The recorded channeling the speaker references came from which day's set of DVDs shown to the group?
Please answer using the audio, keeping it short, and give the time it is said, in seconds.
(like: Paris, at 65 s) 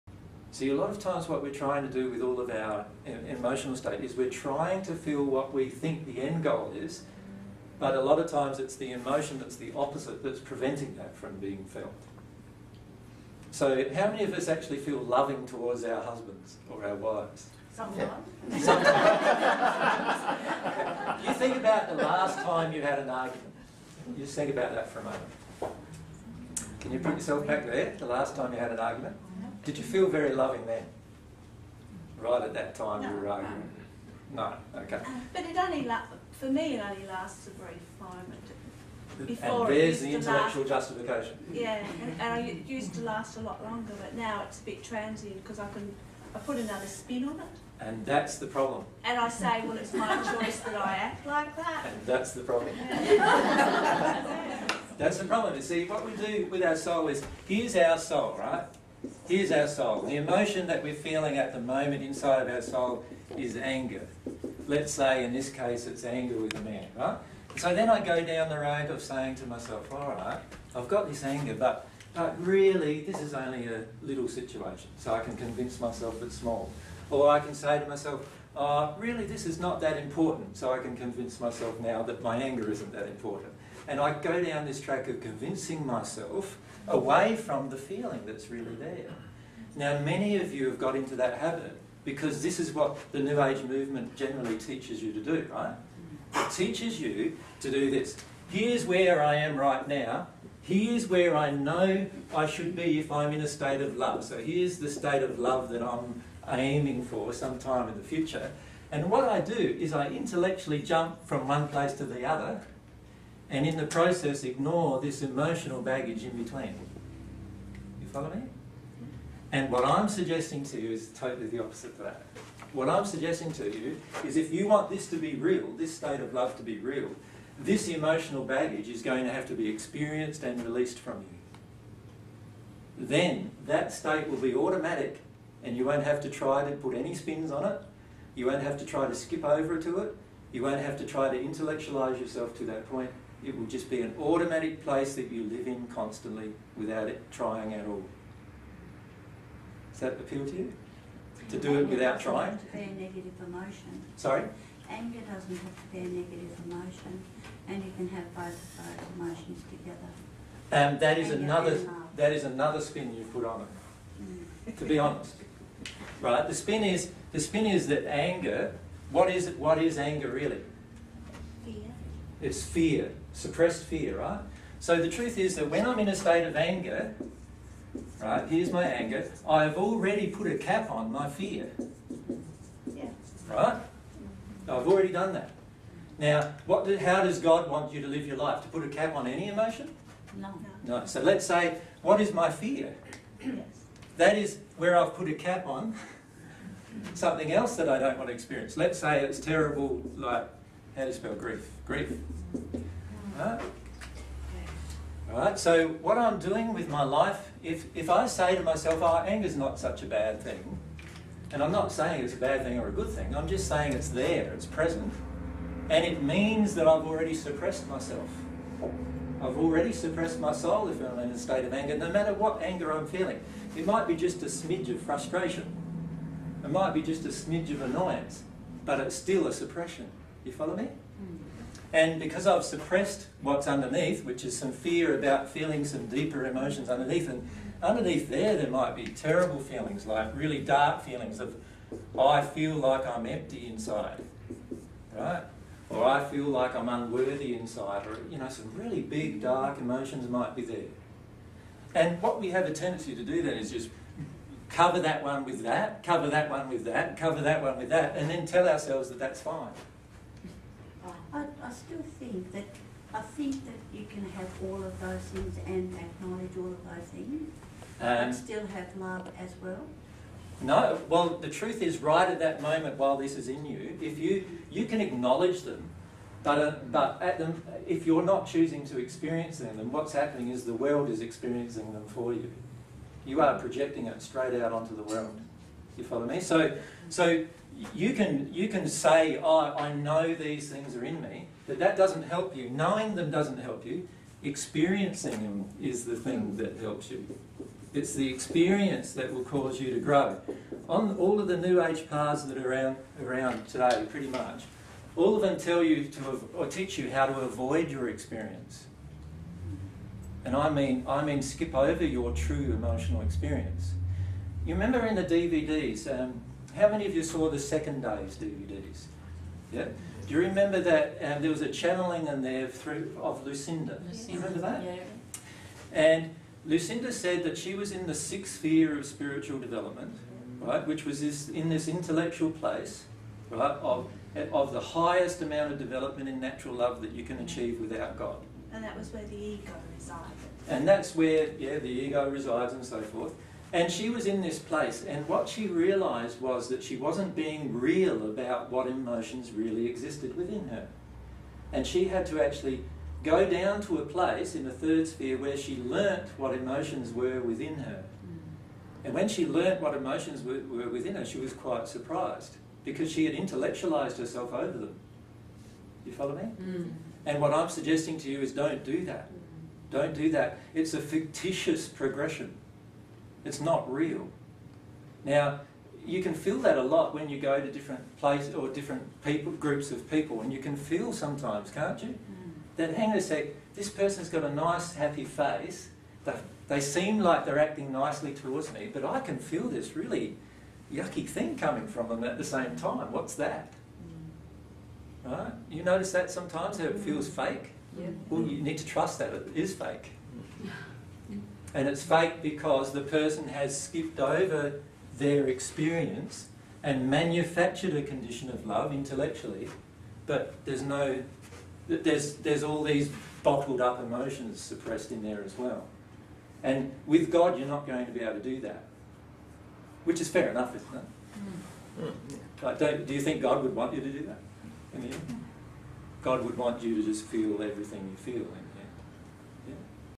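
Second day, at 317 s.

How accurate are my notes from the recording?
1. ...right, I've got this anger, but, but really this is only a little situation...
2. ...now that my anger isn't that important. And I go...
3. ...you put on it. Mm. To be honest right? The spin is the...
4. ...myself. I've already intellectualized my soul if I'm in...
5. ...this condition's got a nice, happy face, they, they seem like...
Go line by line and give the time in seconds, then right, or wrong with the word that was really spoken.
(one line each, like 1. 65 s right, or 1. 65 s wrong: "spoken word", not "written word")
1. 70 s right
2. 81 s right
3. 163 s right
4. 217 s wrong: "suppressed", not "intellectualized"
5. 383 s wrong: "person", not "condition".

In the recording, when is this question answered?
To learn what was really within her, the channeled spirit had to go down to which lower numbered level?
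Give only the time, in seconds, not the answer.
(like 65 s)
354 s.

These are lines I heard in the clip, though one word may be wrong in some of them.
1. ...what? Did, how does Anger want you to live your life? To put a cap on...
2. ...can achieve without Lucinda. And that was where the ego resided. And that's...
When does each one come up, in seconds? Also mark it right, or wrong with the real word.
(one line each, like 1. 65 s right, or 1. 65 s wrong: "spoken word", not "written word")
1. 186 s wrong: "God", not "Anger"
2. 337 s wrong: "God", not "Lucinda".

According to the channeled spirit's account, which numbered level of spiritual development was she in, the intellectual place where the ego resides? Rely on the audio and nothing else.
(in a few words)
Sixth sphere.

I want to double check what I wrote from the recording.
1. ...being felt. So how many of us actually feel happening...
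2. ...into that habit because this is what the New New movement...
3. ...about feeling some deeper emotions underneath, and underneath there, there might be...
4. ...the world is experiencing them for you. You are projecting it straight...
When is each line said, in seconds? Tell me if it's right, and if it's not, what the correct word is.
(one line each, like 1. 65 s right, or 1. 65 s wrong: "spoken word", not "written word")
1. 11 s wrong: "loving", not "happening"
2. 90 s wrong: "Age", not "New"
3. 235 s right
4. 280 s right.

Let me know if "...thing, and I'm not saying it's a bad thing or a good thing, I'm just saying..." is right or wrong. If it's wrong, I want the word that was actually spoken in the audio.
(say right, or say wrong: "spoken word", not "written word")
right.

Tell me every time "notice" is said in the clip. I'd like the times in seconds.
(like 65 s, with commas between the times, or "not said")
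395 s.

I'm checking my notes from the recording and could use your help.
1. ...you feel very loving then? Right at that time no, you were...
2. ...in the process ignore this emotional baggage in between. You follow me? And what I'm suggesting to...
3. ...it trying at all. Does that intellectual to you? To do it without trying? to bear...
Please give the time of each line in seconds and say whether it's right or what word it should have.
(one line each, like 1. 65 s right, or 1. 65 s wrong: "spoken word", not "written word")
1. 29 s right
2. 113 s right
3. 147 s wrong: "appeal", not "intellectual".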